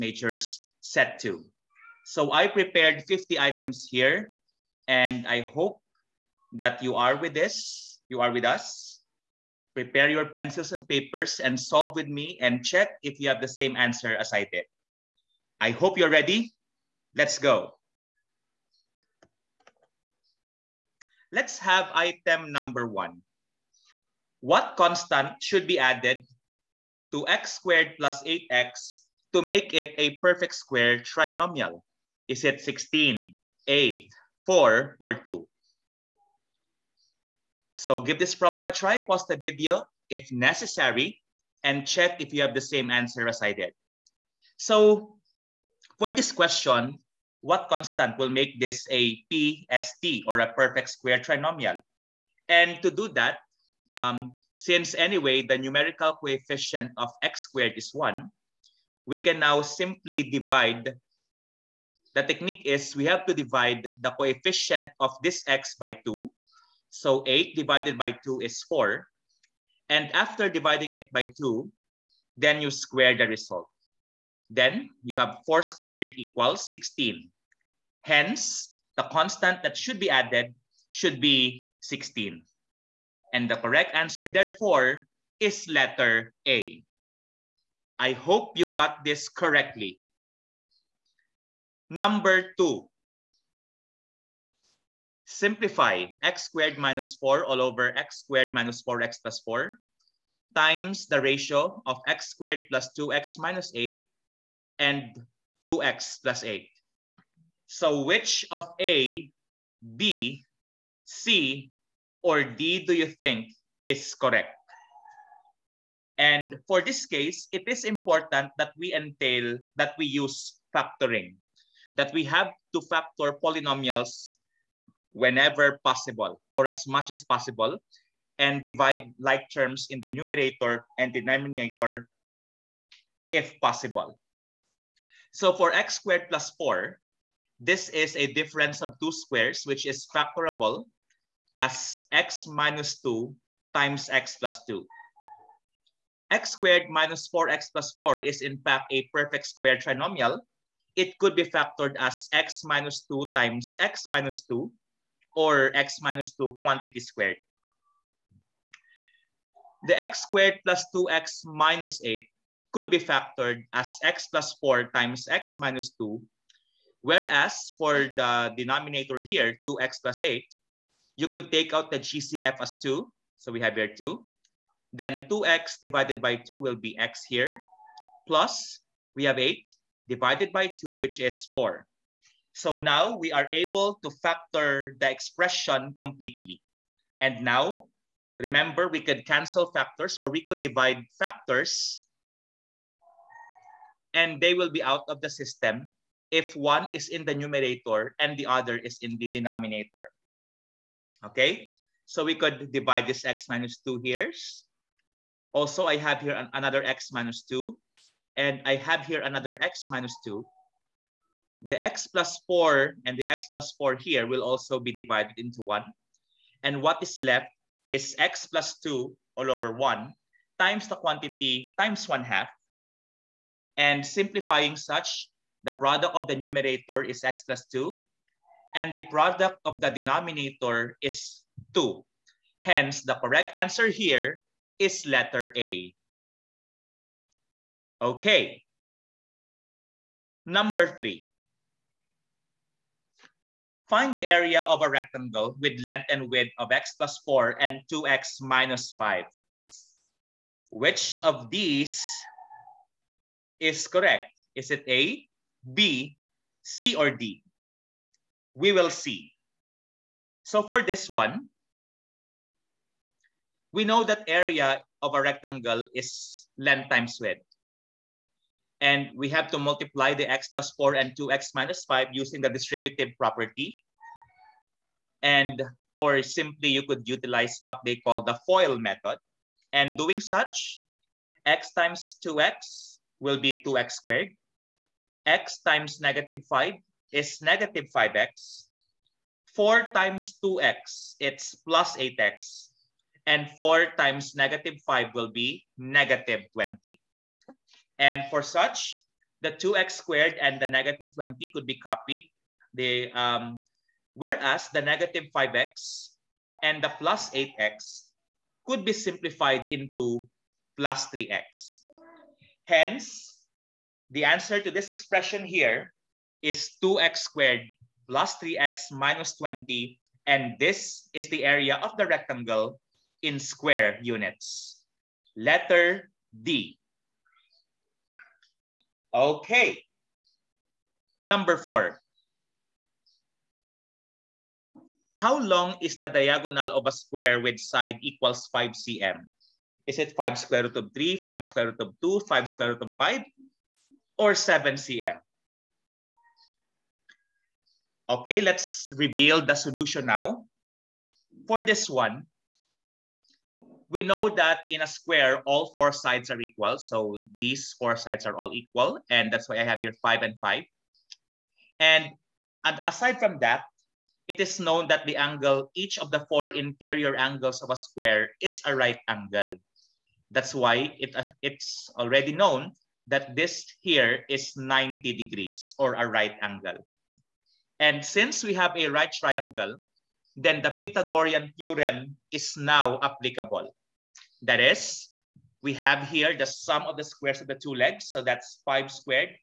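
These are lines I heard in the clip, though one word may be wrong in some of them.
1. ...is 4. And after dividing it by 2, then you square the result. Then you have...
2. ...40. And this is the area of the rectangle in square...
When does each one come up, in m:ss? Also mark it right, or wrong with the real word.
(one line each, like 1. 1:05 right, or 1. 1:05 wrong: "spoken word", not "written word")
1. 1:08 right
2. 5:19 wrong: "20", not "40".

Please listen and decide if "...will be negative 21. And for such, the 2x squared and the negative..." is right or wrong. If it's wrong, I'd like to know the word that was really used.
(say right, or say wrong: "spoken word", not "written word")
wrong: "20", not "21".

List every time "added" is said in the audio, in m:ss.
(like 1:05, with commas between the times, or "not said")
0:25, 1:20.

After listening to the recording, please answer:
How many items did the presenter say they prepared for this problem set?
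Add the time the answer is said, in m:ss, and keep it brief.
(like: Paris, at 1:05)
50, at 0:03.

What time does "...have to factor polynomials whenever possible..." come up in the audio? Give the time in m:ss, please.
2:02.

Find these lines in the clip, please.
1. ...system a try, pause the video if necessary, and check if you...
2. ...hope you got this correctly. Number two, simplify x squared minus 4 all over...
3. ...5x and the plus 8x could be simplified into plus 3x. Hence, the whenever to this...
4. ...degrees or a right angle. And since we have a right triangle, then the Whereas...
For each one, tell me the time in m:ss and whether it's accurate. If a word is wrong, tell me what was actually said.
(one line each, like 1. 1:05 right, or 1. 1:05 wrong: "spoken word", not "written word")
1. 0:38 wrong: "problem", not "system"
2. 1:28 right
3. 5:05 wrong: "answer", not "whenever"
4. 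6:15 wrong: "Pythagorean", not "Whereas".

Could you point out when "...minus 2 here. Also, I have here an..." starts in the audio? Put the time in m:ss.
3:23.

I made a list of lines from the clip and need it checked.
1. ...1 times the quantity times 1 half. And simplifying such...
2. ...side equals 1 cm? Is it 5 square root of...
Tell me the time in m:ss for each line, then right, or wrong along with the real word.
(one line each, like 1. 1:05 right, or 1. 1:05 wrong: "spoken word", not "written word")
1. 3:39 right
2. 5:37 wrong: "5", not "1".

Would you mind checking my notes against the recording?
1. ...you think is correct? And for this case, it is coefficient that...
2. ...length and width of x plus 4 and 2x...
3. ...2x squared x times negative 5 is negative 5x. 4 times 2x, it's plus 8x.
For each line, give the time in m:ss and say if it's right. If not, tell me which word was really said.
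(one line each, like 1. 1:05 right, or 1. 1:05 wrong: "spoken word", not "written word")
1. 1:52 wrong: "important", not "coefficient"
2. 4:05 right
3. 4:43 right.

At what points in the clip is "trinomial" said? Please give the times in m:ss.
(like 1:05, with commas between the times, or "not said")
0:31, 0:51, 2:29.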